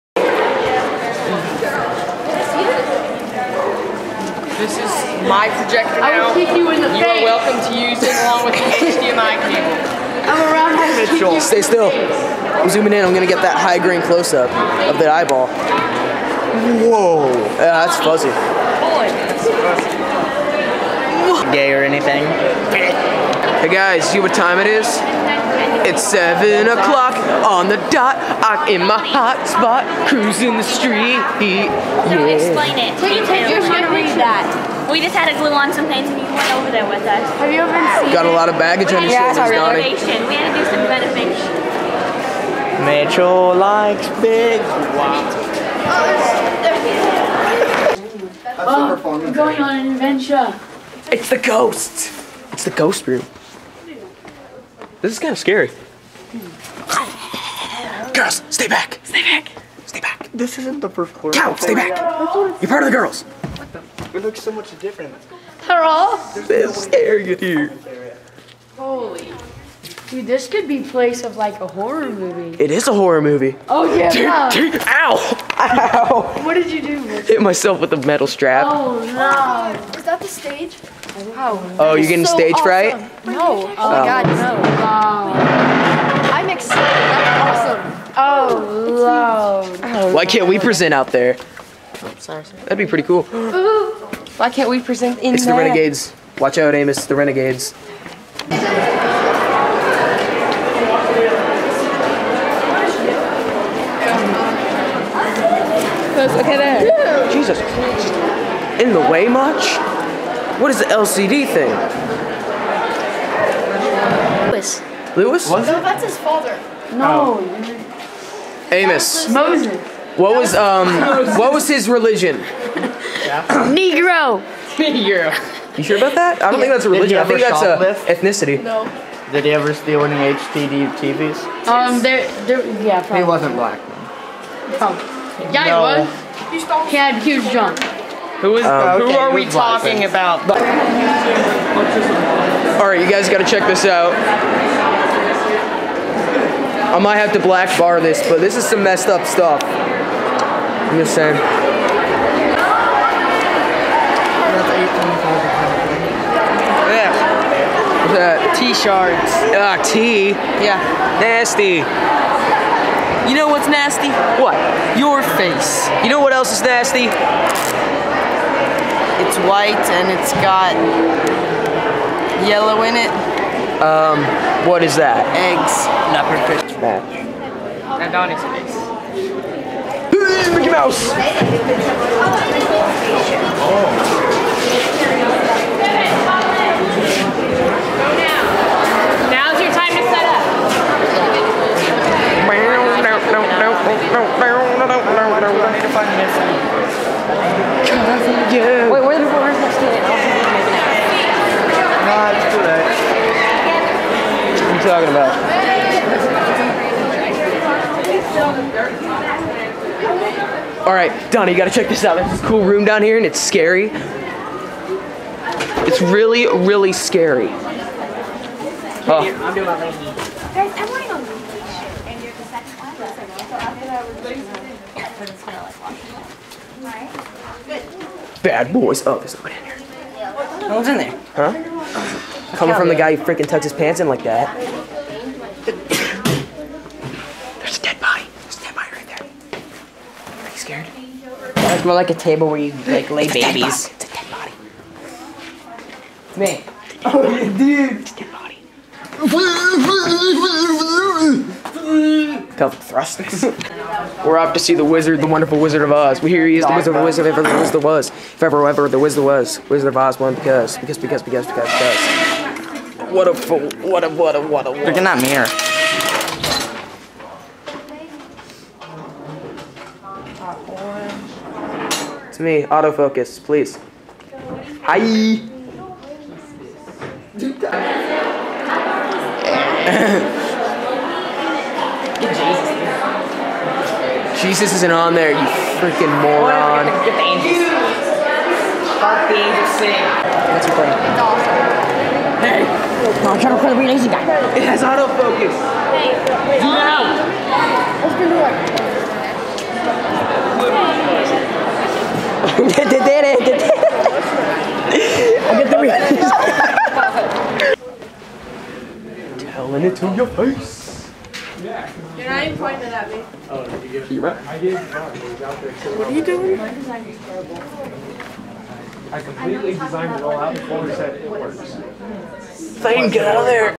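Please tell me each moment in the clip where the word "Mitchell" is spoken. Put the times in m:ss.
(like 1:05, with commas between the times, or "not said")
0:10, 0:42.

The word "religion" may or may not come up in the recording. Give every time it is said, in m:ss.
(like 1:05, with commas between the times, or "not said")
2:01, 2:06.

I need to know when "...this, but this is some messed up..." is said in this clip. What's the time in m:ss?
2:28.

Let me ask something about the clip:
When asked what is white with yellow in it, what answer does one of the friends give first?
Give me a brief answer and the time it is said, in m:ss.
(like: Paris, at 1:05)
Eggs, at 2:55.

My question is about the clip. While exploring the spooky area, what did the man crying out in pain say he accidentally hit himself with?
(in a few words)
A metal strap.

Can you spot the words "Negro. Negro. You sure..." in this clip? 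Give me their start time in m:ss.
2:03.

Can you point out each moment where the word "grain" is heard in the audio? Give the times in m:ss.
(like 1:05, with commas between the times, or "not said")
0:13.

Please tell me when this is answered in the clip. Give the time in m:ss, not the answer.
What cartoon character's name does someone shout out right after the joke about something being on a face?
3:00.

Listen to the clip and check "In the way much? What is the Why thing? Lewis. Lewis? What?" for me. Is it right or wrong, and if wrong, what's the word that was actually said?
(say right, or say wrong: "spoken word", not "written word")
wrong: "LCD", not "Why".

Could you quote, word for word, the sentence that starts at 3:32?
There's this cool room down here and it's scary.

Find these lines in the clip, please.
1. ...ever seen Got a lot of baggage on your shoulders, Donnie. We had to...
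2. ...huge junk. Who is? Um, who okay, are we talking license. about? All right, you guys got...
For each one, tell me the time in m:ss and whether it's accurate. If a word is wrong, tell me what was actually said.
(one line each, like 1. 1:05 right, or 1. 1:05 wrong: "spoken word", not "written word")
1. 0:37 right
2. 2:17 right.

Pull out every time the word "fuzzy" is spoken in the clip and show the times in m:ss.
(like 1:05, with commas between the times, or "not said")
0:17.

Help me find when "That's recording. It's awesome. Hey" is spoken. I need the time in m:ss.
4:50.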